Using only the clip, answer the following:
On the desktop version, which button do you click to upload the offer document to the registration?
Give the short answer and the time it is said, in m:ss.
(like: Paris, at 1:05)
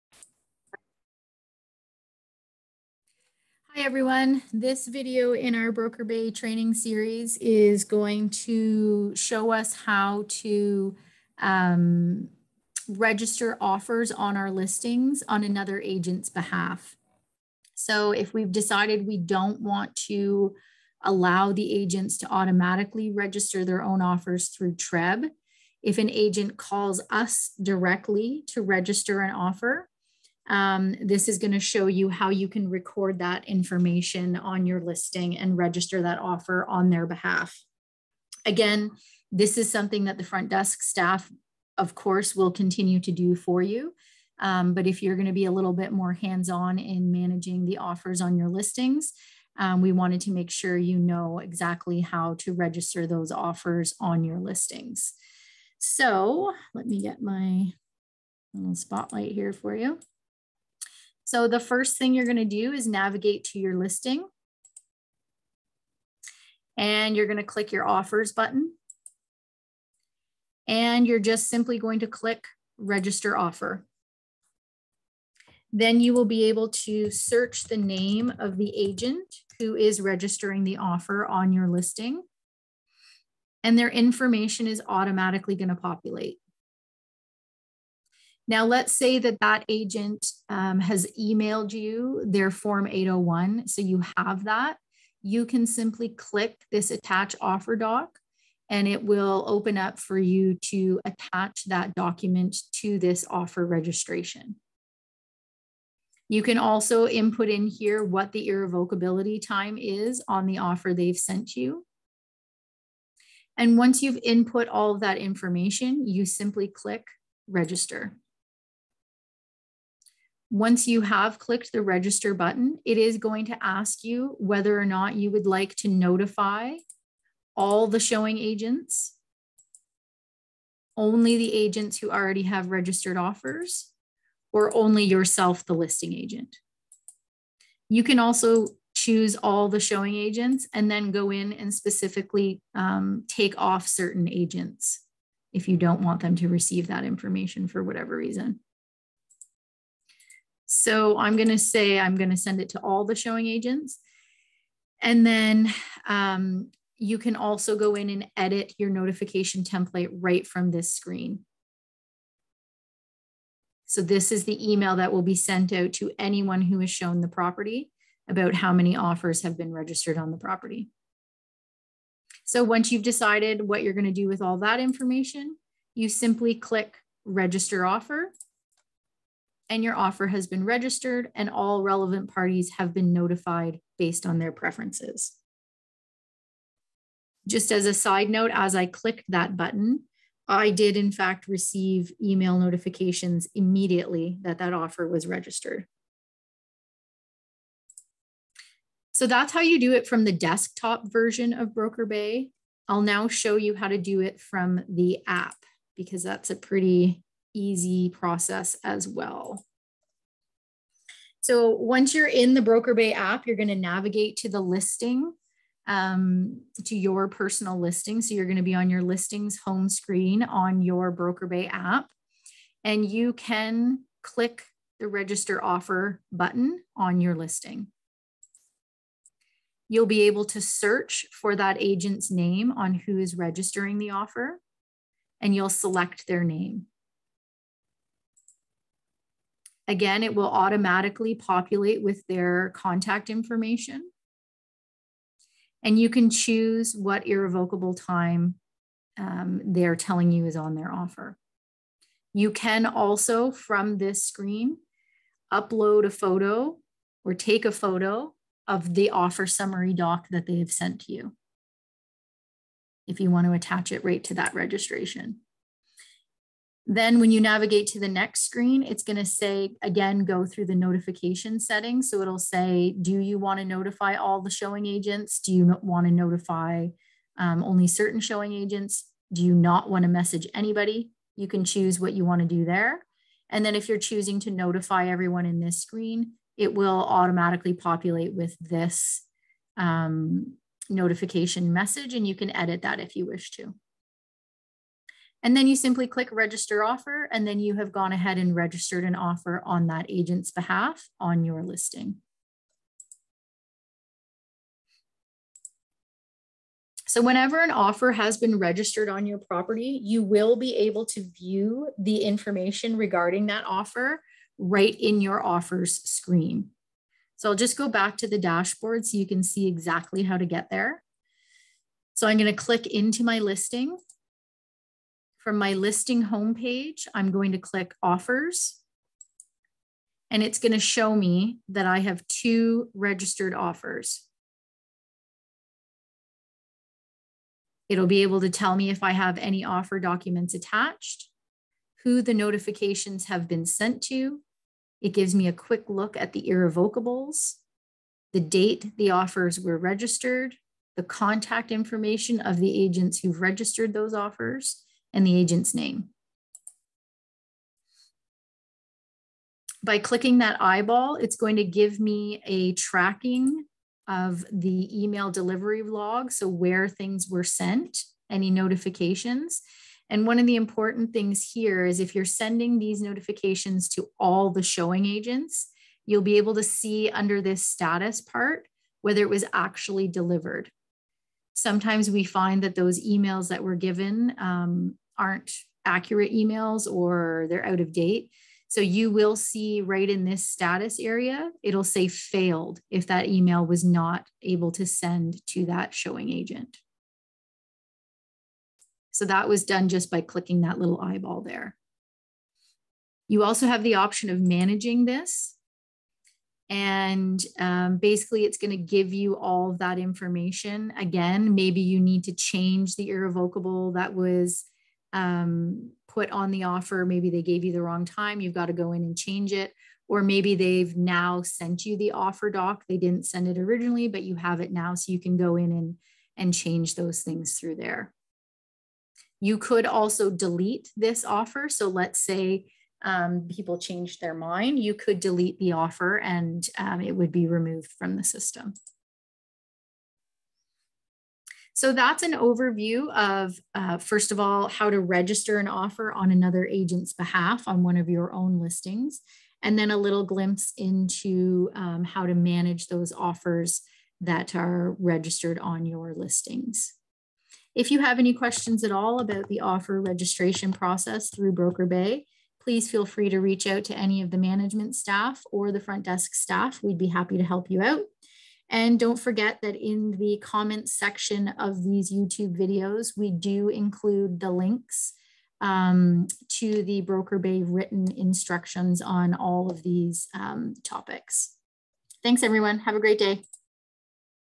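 attach offer doc, at 1:36.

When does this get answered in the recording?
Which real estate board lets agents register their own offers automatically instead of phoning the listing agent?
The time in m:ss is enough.
0:24.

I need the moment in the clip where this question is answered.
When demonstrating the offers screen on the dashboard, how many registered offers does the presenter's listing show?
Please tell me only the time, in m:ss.
5:32.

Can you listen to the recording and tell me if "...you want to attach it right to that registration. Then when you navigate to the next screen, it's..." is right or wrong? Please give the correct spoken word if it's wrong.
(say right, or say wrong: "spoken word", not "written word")
right.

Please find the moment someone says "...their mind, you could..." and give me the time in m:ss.
7:14.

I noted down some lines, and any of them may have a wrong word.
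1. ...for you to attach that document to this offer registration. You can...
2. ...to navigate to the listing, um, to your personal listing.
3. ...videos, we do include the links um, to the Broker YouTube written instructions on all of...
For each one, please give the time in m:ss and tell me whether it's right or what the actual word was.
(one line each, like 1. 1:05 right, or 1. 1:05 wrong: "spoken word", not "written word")
1. 1:39 right
2. 3:33 right
3. 7:52 wrong: "Bay", not "YouTube".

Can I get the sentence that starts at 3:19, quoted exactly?
So that's how you do it from the desktop version of Broker Bay.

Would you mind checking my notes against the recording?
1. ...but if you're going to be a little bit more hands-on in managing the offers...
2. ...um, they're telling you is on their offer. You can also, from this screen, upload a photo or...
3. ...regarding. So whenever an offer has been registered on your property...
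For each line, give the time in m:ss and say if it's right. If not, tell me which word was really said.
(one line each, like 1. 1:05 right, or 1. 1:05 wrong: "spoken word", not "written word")
1. 0:44 right
2. 4:09 right
3. 5:01 wrong: "listing", not "regarding".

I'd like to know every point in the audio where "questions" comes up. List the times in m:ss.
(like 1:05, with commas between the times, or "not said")
7:38.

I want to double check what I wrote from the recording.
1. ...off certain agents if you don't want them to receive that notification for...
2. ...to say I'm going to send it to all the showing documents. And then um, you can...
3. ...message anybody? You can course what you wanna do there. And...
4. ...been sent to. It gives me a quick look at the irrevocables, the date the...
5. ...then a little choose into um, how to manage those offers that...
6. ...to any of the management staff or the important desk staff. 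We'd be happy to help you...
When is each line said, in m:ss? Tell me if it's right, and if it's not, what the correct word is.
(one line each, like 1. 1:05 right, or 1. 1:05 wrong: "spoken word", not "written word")
1. 2:23 wrong: "information", not "notification"
2. 2:31 wrong: "agents", not "documents"
3. 4:40 wrong: "choose", not "course"
4. 5:43 right
5. 7:29 wrong: "glimpse", not "choose"
6. 7:43 wrong: "front", not "important".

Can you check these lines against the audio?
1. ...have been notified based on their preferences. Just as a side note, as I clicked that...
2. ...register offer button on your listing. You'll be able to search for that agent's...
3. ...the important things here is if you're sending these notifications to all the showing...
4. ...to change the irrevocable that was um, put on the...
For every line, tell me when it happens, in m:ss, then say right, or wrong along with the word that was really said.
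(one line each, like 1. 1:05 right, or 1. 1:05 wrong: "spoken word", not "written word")
1. 3:02 right
2. 3:45 right
3. 6:10 right
4. 6:52 right.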